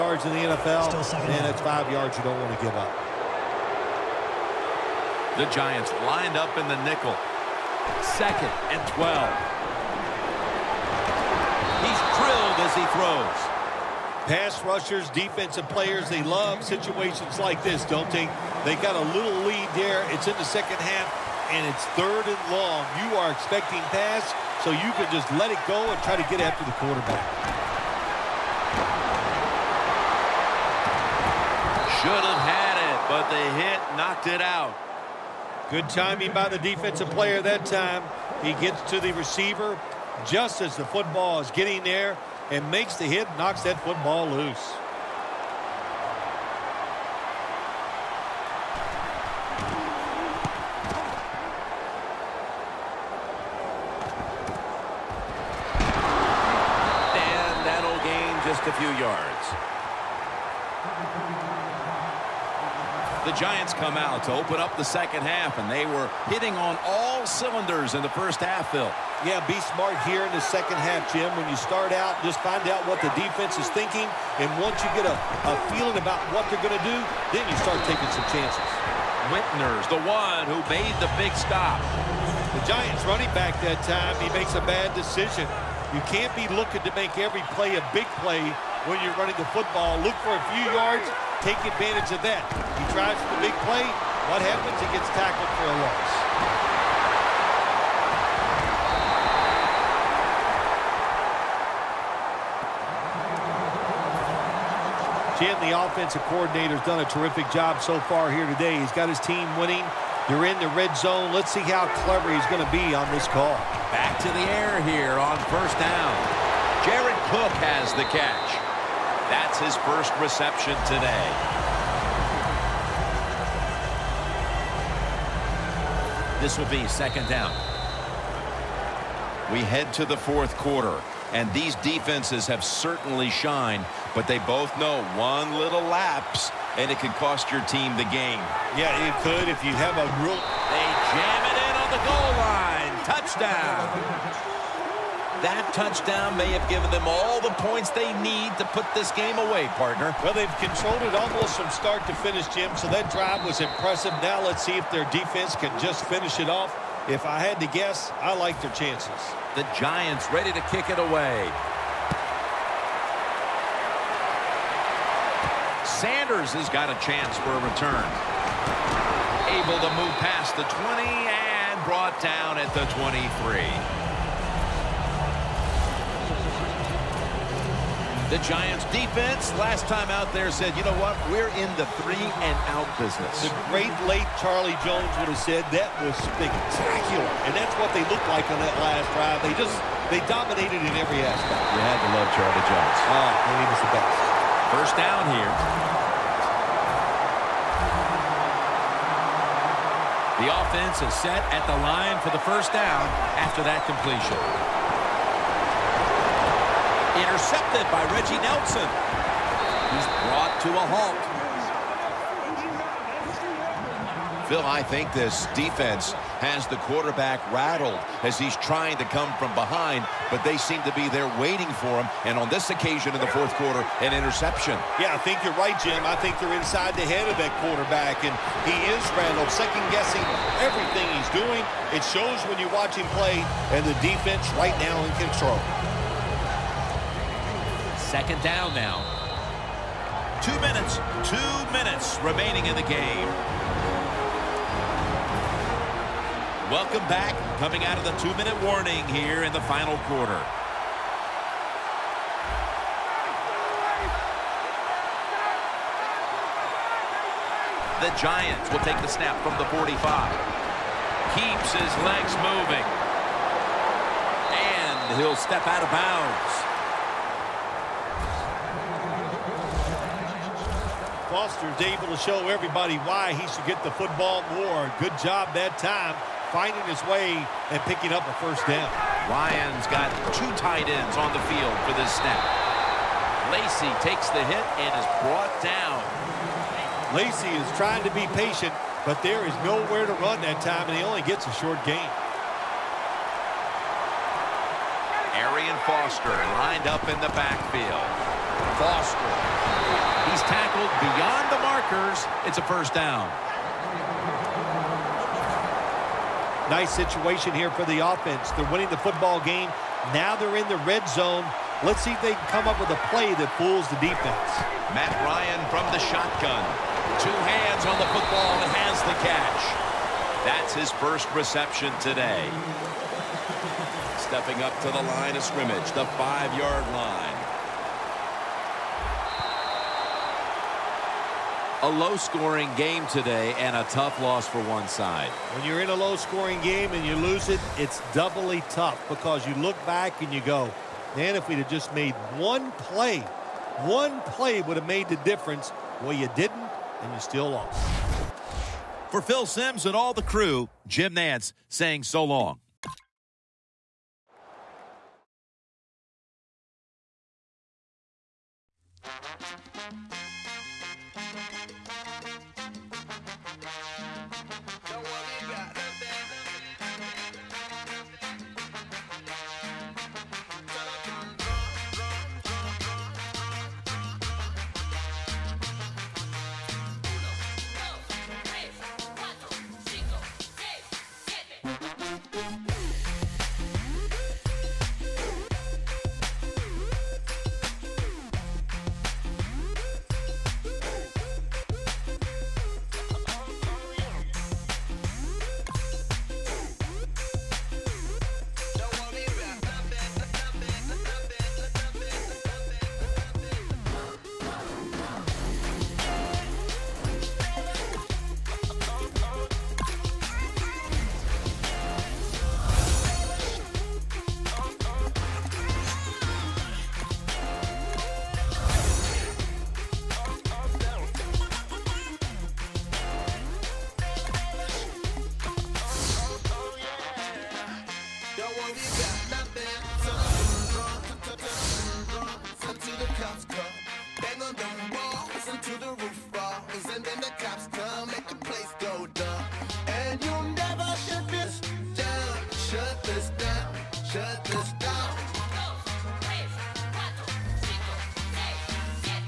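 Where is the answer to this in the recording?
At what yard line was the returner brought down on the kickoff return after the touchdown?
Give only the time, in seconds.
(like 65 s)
172 s.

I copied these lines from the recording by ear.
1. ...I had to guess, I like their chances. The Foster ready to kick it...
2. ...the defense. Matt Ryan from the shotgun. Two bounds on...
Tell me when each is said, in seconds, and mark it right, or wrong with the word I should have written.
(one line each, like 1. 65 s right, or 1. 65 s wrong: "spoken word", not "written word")
1. 157 s wrong: "Giants", not "Foster"
2. 313 s wrong: "hands", not "bounds".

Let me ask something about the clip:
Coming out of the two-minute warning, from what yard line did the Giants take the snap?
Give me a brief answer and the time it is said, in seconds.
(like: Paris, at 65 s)
45, at 259 s.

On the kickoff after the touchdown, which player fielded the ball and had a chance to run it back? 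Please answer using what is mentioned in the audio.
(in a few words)
Sanders.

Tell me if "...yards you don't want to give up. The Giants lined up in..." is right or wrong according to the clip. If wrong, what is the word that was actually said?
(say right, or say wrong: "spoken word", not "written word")
right.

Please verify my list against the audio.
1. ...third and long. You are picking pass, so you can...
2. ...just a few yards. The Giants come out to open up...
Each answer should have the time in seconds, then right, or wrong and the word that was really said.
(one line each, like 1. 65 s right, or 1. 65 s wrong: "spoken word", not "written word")
1. 21 s wrong: "expecting", not "picking"
2. 58 s right.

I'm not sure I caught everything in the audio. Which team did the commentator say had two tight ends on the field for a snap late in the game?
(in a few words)
Lions.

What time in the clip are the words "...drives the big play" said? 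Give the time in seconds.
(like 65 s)
92 s.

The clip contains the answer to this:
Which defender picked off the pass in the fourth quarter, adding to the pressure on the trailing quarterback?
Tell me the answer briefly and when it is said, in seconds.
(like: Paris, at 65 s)
Reggie Nelson, at 208 s.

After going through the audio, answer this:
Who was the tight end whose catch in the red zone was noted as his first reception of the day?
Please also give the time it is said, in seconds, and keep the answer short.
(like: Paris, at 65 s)
Jared Cook, at 116 s.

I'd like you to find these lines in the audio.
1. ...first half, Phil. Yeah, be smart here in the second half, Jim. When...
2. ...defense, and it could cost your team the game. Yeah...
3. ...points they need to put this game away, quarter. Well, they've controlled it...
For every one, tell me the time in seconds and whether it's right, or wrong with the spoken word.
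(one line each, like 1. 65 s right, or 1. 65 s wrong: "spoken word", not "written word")
1. 68 s right
2. 135 s wrong: "lapse", not "defense"
3. 147 s wrong: "partner", not "quarter".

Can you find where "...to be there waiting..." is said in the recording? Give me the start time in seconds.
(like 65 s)
220 s.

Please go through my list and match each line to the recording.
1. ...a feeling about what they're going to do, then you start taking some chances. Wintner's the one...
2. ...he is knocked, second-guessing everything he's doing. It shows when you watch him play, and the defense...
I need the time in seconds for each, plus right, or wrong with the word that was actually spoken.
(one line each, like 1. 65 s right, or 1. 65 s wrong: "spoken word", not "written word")
1. 75 s right
2. 228 s wrong: "rattled", not "knocked".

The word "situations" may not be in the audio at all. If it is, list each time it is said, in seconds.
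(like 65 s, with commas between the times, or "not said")
16 s, 306 s.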